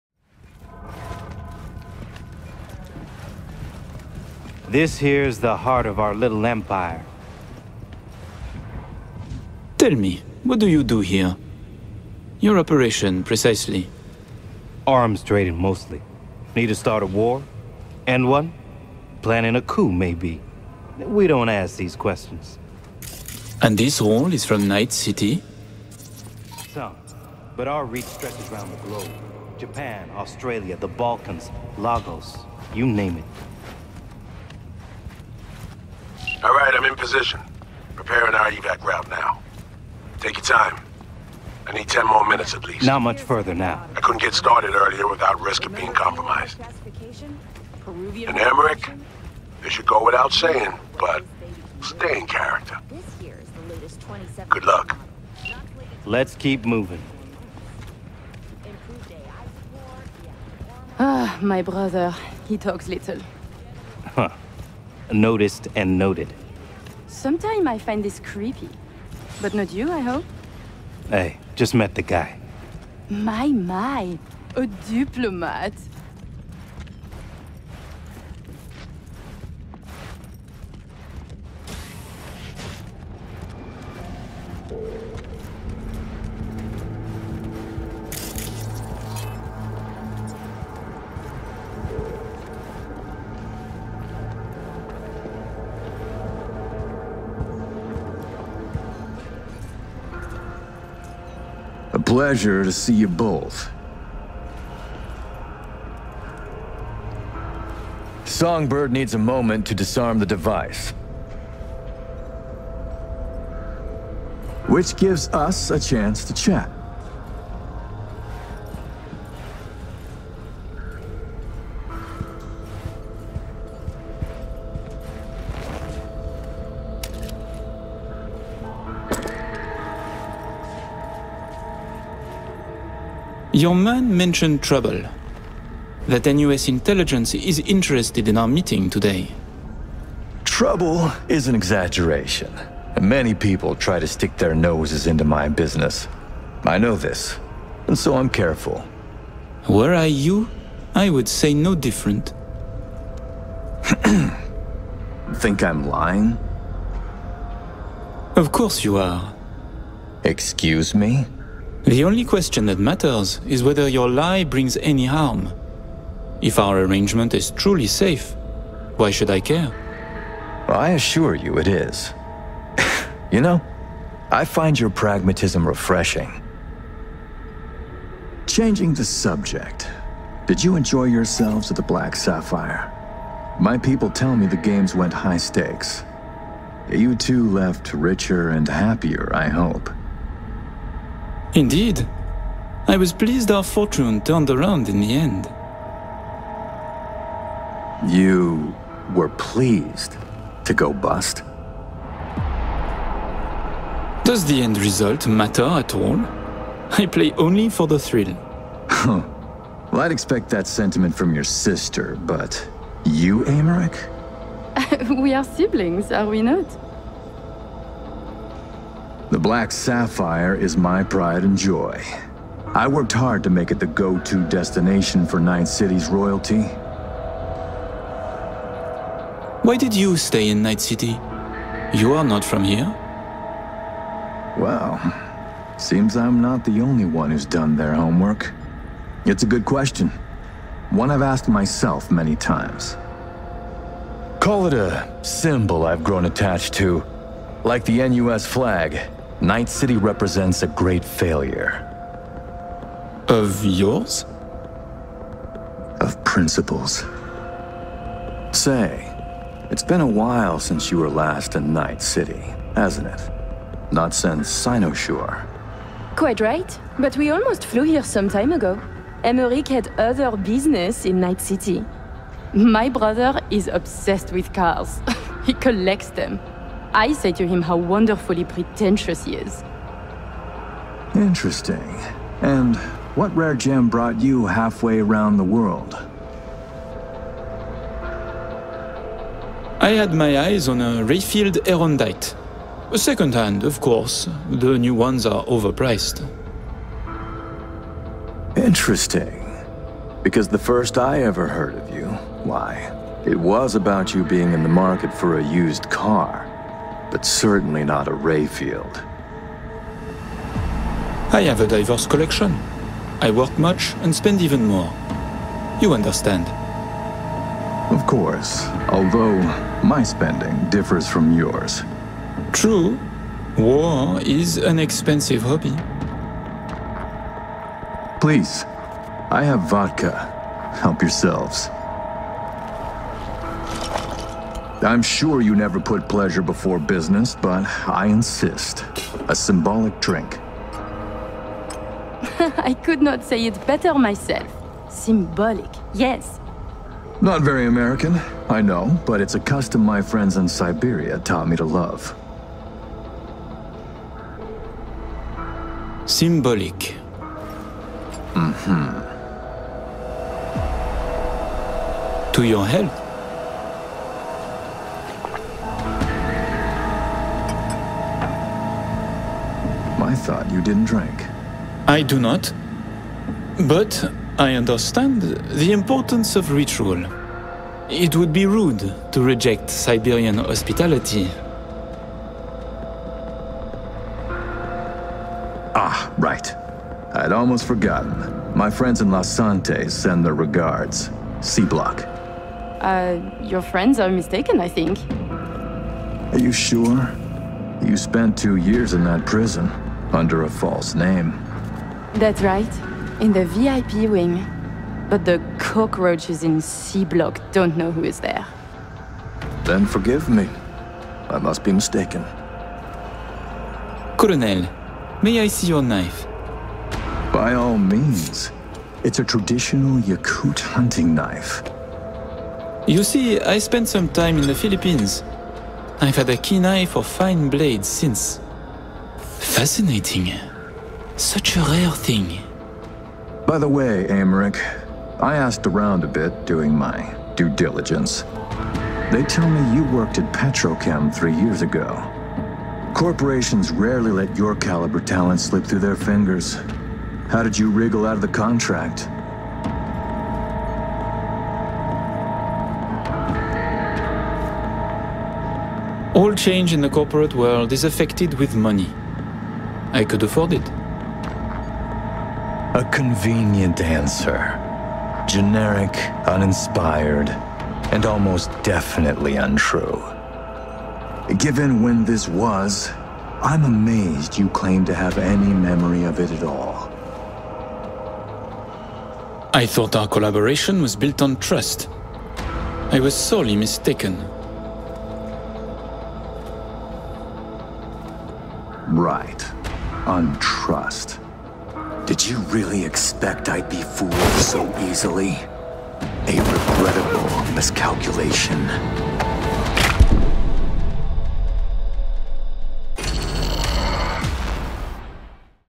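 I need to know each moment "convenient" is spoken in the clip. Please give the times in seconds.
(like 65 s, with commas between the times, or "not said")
462 s.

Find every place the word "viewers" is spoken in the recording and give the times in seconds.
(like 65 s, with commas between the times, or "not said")
not said.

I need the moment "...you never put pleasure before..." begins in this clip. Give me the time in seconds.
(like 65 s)
335 s.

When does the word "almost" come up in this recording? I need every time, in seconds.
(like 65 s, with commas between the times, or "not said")
267 s, 387 s, 468 s.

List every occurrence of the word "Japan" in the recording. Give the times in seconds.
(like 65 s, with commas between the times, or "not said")
29 s.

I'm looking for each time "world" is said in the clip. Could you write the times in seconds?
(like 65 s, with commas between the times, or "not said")
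285 s, 457 s.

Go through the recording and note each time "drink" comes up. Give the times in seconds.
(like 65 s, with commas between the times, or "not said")
339 s, 370 s.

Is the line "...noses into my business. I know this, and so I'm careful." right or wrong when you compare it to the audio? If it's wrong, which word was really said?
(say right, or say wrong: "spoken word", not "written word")
right.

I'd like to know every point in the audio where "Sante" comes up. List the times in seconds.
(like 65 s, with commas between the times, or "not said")
389 s.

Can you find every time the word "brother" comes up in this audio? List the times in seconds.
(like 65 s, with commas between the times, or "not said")
61 s, 272 s.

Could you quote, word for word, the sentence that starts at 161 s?
The only question that matters is whether your lie brings any harm.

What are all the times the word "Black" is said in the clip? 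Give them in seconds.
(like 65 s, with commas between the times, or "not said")
181 s, 219 s.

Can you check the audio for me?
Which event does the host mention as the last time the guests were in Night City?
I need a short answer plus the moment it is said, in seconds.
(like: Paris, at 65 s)
Sinoshore, at 264 s.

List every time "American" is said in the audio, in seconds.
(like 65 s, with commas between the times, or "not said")
347 s.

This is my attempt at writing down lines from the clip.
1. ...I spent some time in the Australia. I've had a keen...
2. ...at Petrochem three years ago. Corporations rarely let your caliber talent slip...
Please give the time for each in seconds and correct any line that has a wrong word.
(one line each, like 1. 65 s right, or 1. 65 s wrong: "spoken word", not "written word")
1. 423 s wrong: "Philippines", not "Australia"
2. 440 s right.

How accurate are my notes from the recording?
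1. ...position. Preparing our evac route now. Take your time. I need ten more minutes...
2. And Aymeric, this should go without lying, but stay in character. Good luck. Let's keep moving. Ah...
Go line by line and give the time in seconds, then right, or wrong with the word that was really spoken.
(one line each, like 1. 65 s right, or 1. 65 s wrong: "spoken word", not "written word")
1. 36 s right
2. 47 s wrong: "saying", not "lying".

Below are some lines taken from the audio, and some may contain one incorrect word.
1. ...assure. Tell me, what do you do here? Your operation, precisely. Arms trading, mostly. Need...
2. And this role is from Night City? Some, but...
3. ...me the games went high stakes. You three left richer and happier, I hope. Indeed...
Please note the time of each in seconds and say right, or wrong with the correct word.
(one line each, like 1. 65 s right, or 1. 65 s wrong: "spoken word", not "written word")
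1. 6 s wrong: "empire", not "assure"
2. 23 s right
3. 184 s wrong: "two", not "three".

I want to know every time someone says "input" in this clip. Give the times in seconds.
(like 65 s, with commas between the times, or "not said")
not said.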